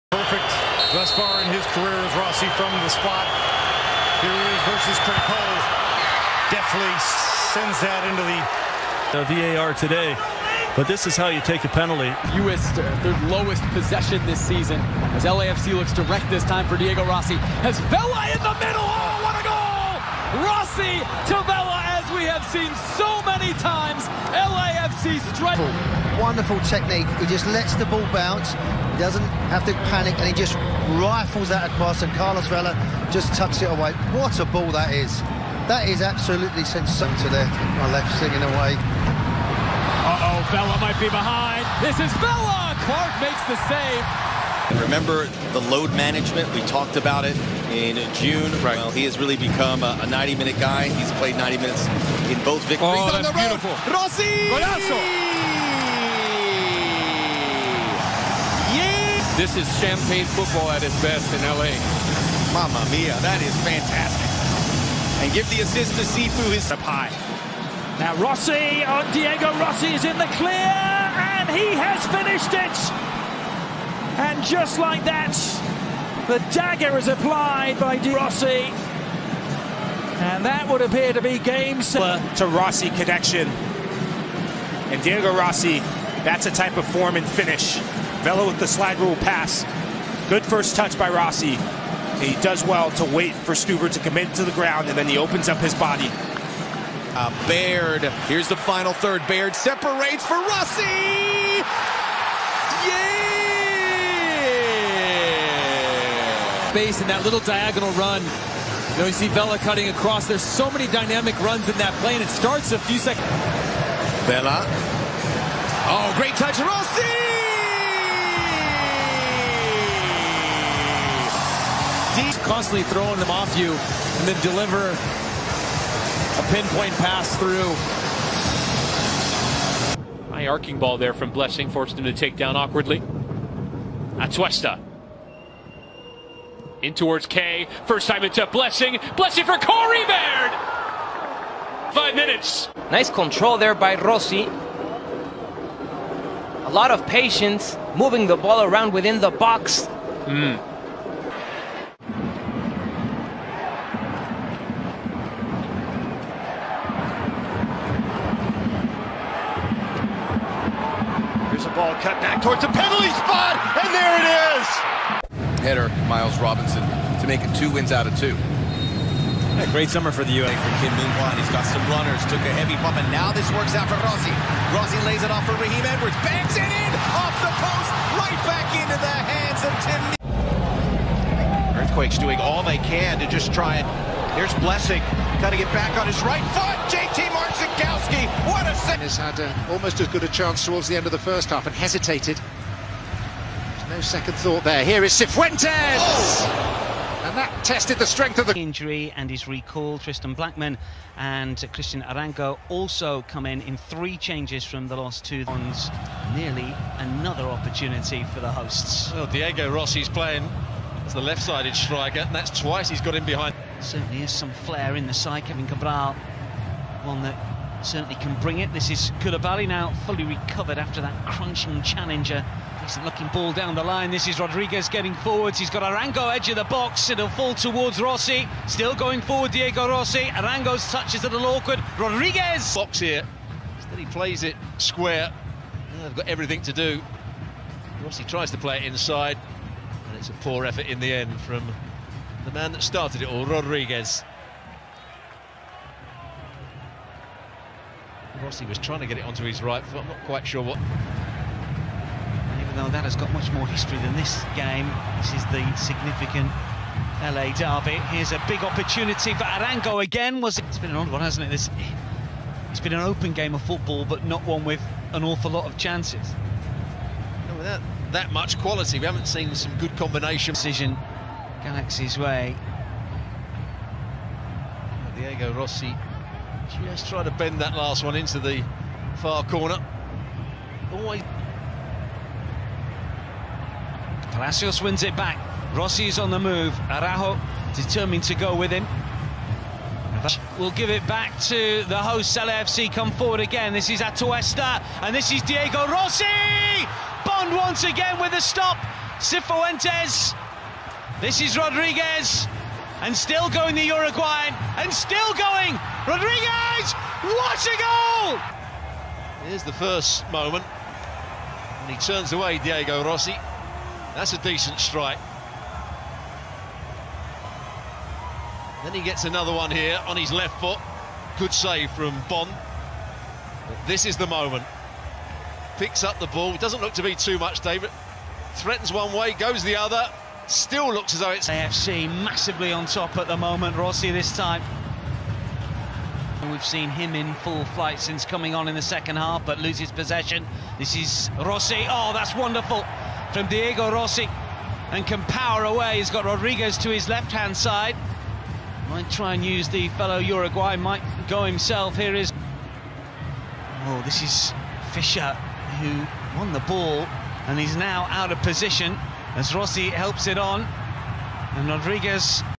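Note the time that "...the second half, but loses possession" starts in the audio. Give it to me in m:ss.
5:38.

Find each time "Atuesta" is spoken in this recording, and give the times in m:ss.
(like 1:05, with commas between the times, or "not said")
2:14, 4:54.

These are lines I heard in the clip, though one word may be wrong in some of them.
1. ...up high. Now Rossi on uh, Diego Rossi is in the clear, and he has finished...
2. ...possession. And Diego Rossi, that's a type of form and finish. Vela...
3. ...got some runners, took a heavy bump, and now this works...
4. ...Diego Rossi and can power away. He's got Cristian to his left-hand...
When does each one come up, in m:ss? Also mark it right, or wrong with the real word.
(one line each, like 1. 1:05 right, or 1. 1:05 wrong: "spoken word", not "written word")
1. 1:06 right
2. 1:22 wrong: "connection", not "possession"
3. 2:51 right
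4. 5:43 wrong: "Rodriguez", not "Cristian".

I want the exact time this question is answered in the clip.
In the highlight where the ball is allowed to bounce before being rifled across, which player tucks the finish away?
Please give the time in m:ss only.
0:32.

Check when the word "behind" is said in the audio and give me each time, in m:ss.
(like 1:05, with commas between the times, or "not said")
0:41, 3:33.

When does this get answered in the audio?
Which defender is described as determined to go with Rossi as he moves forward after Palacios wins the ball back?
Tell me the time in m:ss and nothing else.
4:46.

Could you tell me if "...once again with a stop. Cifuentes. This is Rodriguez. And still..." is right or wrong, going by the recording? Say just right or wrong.
right.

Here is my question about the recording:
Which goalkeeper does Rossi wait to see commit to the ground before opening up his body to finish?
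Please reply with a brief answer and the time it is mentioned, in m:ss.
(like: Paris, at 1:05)
Stuber, at 1:33.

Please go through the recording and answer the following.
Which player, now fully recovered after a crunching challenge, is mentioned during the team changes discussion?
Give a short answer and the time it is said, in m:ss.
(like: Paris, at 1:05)
Koulibaly, at 3:39.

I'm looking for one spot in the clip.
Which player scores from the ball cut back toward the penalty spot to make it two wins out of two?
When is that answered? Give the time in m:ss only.
2:46.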